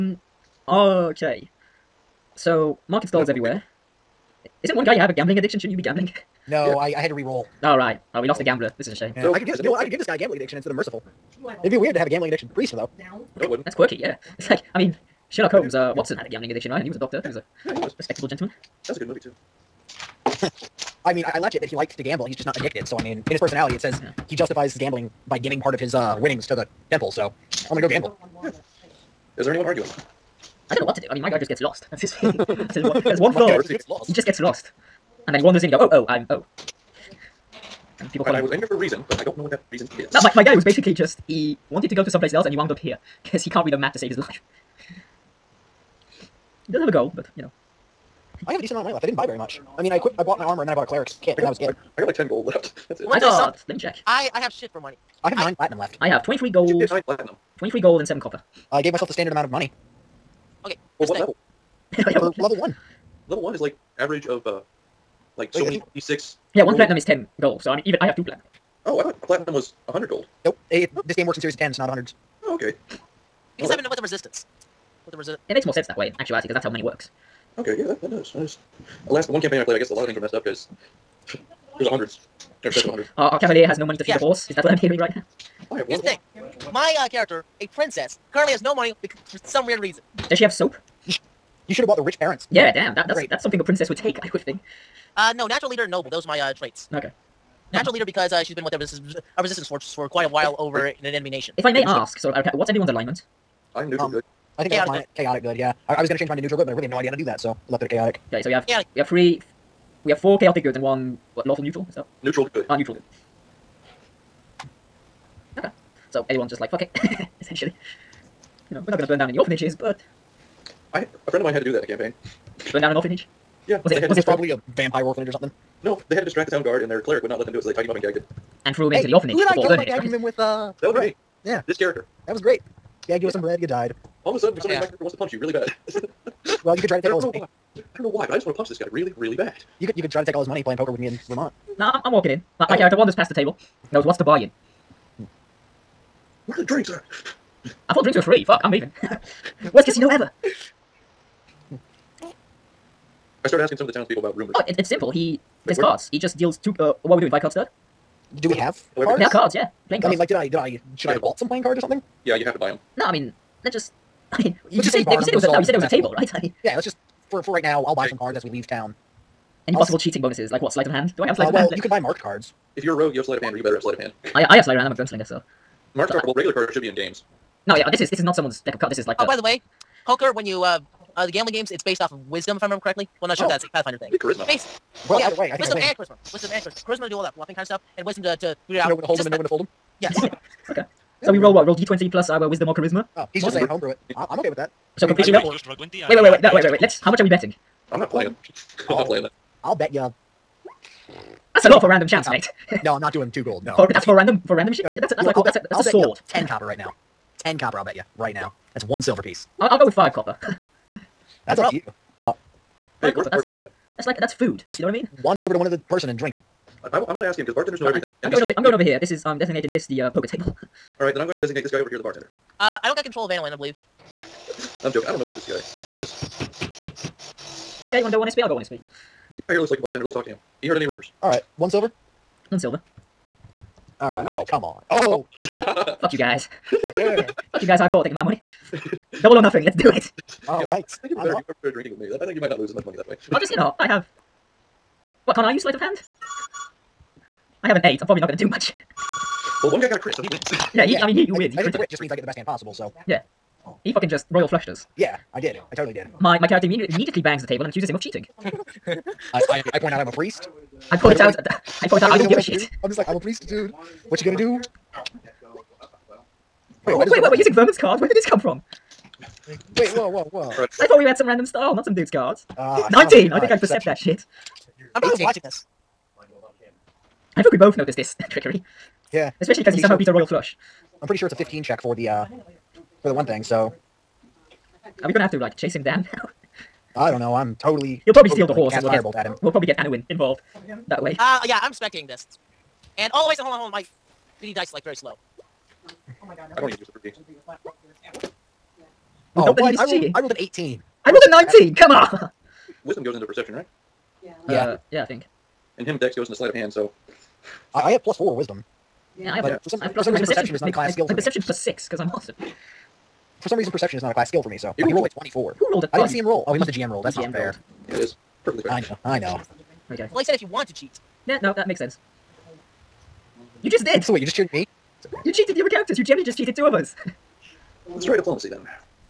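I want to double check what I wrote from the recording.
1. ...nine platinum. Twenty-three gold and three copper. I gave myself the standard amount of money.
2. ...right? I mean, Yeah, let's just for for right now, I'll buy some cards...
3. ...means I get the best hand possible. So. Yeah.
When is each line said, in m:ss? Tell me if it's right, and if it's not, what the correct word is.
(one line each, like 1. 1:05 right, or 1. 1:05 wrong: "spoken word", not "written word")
1. 0:56 wrong: "seven", not "three"
2. 2:46 right
3. 4:11 right.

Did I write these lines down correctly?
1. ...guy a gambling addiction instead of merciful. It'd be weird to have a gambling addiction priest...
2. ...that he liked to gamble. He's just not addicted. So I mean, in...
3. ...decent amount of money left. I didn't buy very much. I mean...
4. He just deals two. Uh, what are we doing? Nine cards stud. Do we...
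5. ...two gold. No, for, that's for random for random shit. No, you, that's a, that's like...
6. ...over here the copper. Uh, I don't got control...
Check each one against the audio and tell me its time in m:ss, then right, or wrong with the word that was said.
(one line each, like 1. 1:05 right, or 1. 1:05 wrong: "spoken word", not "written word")
1. 0:10 right
2. 0:21 right
3. 0:48 right
4. 2:36 wrong: "Five", not "Nine"
5. 3:23 right
6. 3:41 wrong: "bartender", not "copper".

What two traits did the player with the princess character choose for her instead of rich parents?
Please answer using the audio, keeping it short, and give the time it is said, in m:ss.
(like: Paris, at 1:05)
natural leader, noble, at 1:35.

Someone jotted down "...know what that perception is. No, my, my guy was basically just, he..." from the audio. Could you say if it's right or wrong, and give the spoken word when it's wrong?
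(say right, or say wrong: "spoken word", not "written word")
wrong: "reason", not "perception".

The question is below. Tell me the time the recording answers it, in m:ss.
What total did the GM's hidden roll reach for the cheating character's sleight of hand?
5:15.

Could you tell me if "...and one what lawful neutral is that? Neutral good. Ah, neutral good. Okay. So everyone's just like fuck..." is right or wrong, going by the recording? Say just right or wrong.
wrong.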